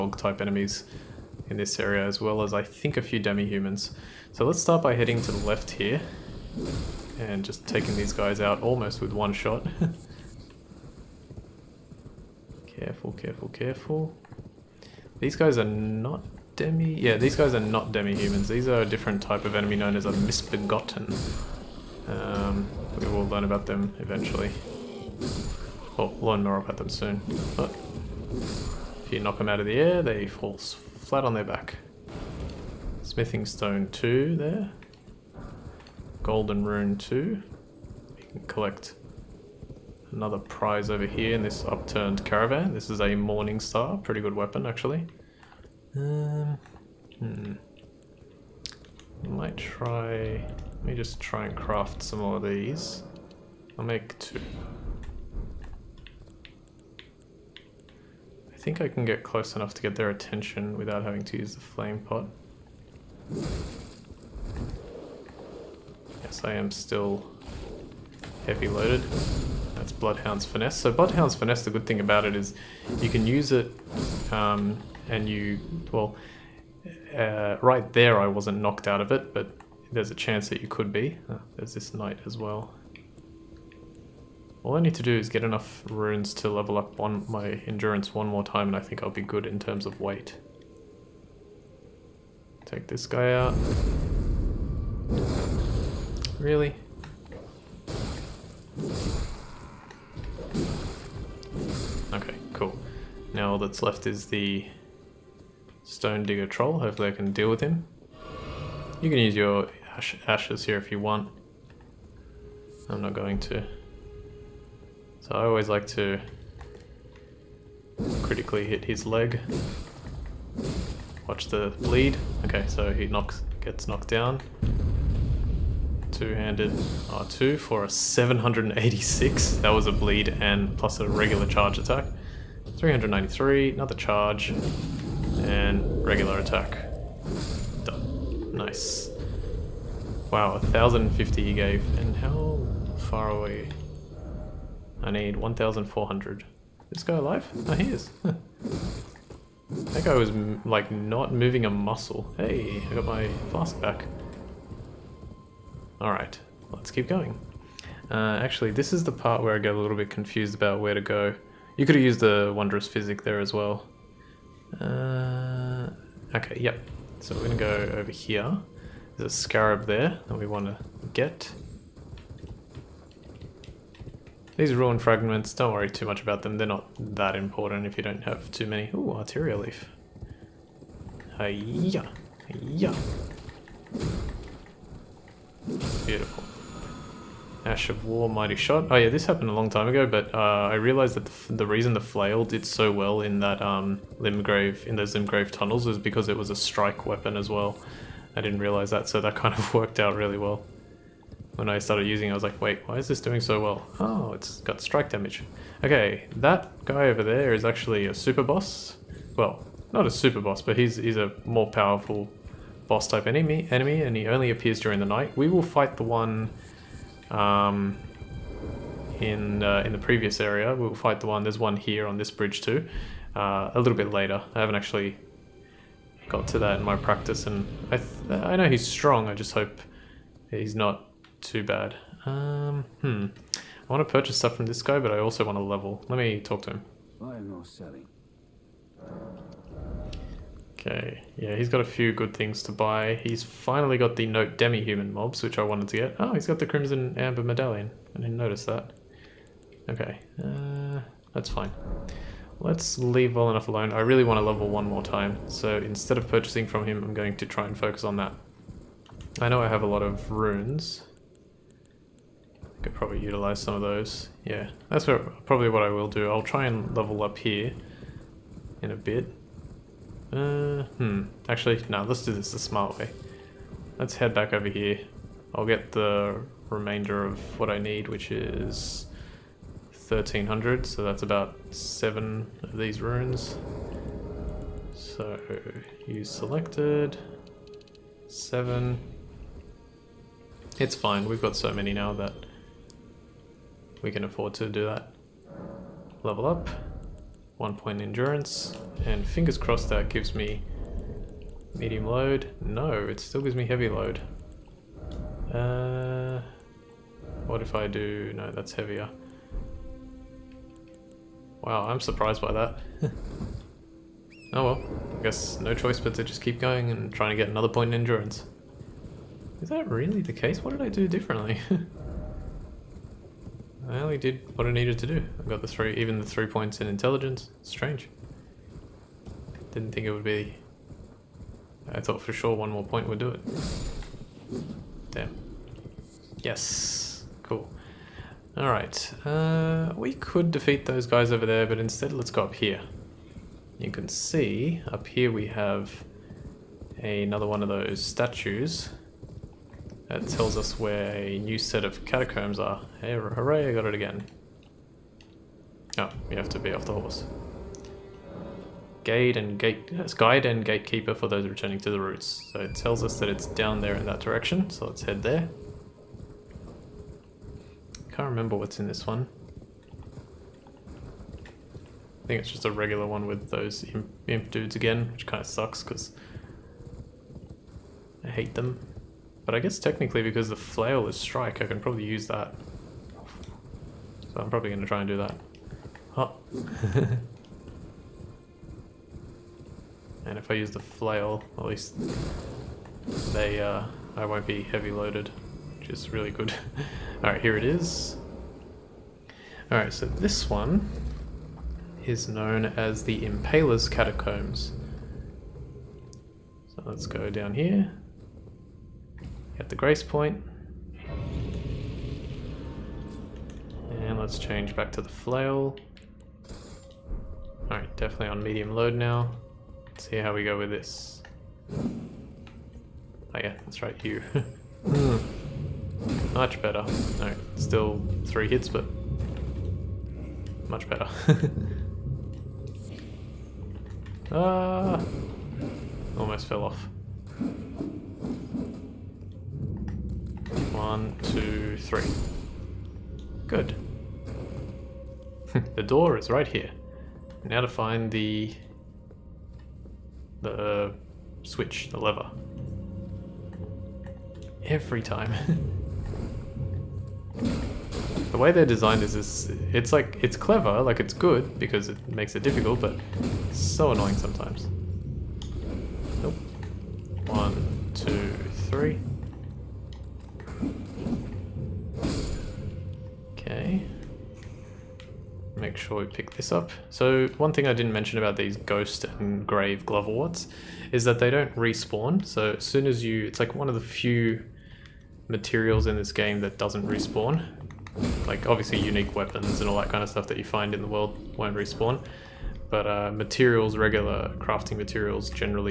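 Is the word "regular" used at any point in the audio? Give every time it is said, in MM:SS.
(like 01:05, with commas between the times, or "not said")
02:11, 02:16, 06:12, 08:13.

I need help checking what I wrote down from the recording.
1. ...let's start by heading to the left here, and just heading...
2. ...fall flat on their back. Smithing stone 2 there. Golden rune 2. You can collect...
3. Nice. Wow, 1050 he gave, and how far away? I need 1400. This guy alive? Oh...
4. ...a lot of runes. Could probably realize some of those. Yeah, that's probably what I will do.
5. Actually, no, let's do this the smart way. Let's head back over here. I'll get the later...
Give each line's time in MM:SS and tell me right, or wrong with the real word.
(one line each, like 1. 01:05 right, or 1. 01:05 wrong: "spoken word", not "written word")
1. 00:04 wrong: "taking", not "heading"
2. 00:30 right
3. 02:18 right
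4. 04:19 wrong: "utilize", not "realize"
5. 04:31 wrong: "remainder", not "later".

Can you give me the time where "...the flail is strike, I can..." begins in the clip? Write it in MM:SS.
06:20.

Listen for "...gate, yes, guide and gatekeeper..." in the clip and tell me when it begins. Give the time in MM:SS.
05:59.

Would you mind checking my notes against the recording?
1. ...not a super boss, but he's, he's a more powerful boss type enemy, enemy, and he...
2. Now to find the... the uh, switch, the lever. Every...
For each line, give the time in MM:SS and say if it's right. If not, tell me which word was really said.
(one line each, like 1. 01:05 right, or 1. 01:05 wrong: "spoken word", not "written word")
1. 03:29 right
2. 07:27 right.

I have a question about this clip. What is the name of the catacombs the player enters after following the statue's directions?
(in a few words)
Impaler's Catacombs.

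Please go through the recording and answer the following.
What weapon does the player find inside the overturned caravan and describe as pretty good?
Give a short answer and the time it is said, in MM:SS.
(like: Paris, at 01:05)
Morning Star, at 00:43.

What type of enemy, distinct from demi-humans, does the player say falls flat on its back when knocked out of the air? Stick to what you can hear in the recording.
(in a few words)
Misbegotten.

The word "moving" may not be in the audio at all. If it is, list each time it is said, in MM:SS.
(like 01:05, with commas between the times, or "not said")
02:31.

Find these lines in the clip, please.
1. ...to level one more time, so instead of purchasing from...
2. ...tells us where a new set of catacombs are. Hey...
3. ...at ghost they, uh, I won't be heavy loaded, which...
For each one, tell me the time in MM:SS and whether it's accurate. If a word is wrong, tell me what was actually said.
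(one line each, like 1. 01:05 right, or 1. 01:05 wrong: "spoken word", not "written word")
1. 04:14 right
2. 05:50 right
3. 06:31 wrong: "least", not "ghost".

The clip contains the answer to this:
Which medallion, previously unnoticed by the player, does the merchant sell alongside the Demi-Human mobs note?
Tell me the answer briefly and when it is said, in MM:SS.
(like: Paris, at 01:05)
Crimson Amber Medallion, at 04:06.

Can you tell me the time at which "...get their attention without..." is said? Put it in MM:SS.
00:59.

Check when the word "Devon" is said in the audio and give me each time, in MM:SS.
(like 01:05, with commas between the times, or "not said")
not said.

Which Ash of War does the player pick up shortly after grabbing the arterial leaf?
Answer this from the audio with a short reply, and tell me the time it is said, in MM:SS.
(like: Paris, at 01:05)
Mighty Shot, at 03:08.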